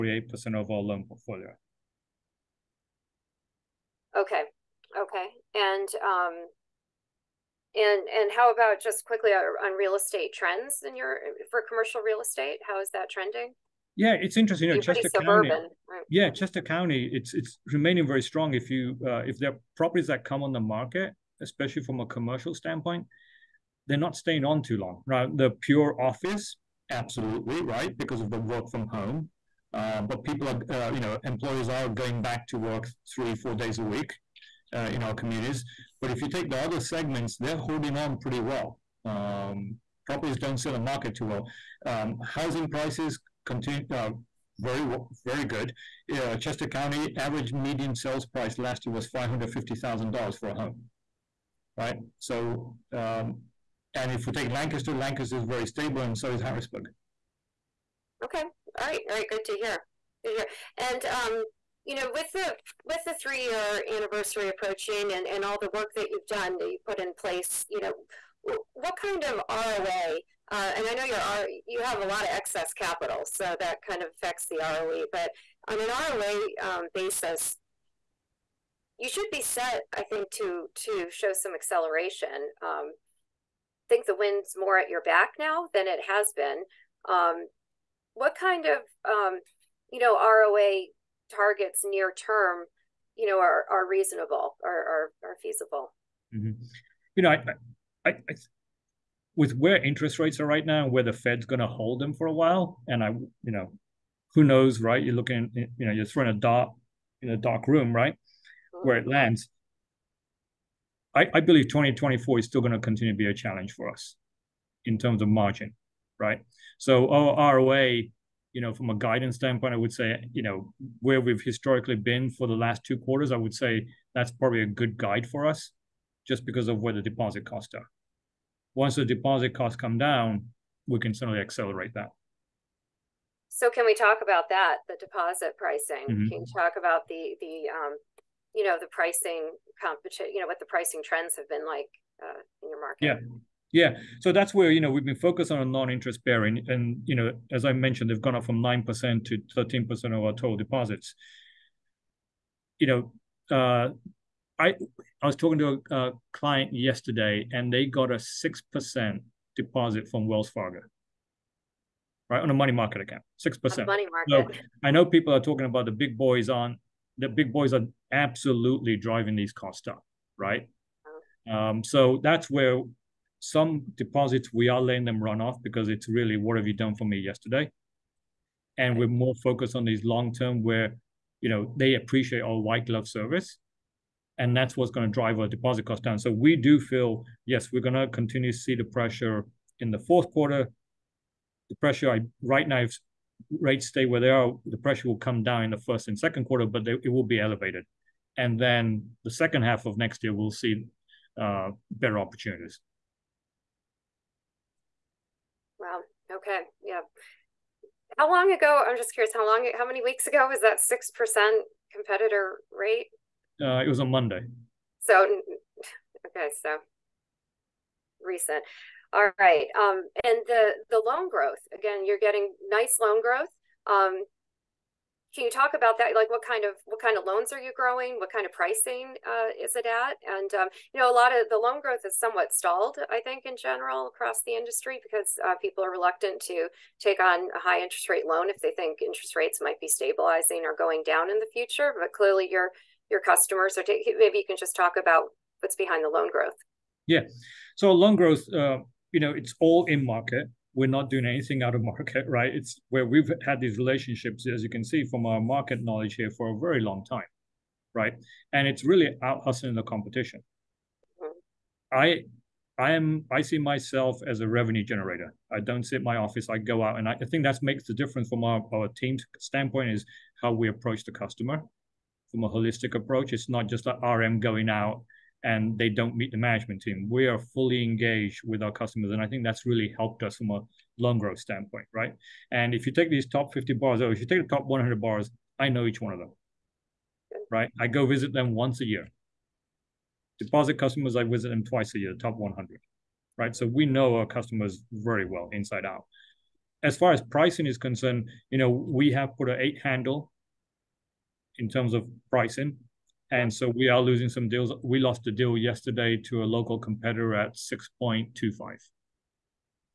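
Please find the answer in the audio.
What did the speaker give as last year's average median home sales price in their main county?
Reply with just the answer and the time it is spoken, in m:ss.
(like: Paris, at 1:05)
$550,000, at 0:49.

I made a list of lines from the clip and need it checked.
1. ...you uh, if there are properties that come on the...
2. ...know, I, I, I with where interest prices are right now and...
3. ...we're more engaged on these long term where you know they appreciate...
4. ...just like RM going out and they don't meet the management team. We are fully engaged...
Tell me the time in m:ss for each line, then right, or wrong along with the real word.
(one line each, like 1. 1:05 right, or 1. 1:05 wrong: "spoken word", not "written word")
1. 0:18 right
2. 1:37 wrong: "rates", not "prices"
3. 2:58 wrong: "focused", not "engaged"
4. 4:33 right.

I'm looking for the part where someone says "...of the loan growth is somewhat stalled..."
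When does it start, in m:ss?
3:51.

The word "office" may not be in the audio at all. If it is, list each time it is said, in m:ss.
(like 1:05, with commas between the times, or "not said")
0:26, 4:26.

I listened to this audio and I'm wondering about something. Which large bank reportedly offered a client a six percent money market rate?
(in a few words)
Wells Fargo.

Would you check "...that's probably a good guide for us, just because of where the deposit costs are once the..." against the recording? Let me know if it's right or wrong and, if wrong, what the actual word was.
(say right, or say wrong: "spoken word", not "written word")
right.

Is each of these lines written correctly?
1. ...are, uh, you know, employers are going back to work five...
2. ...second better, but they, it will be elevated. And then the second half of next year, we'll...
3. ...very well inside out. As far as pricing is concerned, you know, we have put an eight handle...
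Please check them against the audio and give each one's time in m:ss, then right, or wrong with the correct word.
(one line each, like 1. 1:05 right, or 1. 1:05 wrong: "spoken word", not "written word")
1. 0:30 wrong: "three", not "five"
2. 3:16 wrong: "quarter", not "better"
3. 4:54 right.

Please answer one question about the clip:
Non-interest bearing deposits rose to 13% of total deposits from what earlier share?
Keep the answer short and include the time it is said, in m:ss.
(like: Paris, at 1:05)
9%, at 2:28.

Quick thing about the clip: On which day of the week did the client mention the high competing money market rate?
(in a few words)
Monday.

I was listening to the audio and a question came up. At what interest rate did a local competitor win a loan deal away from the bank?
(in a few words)
6.25%.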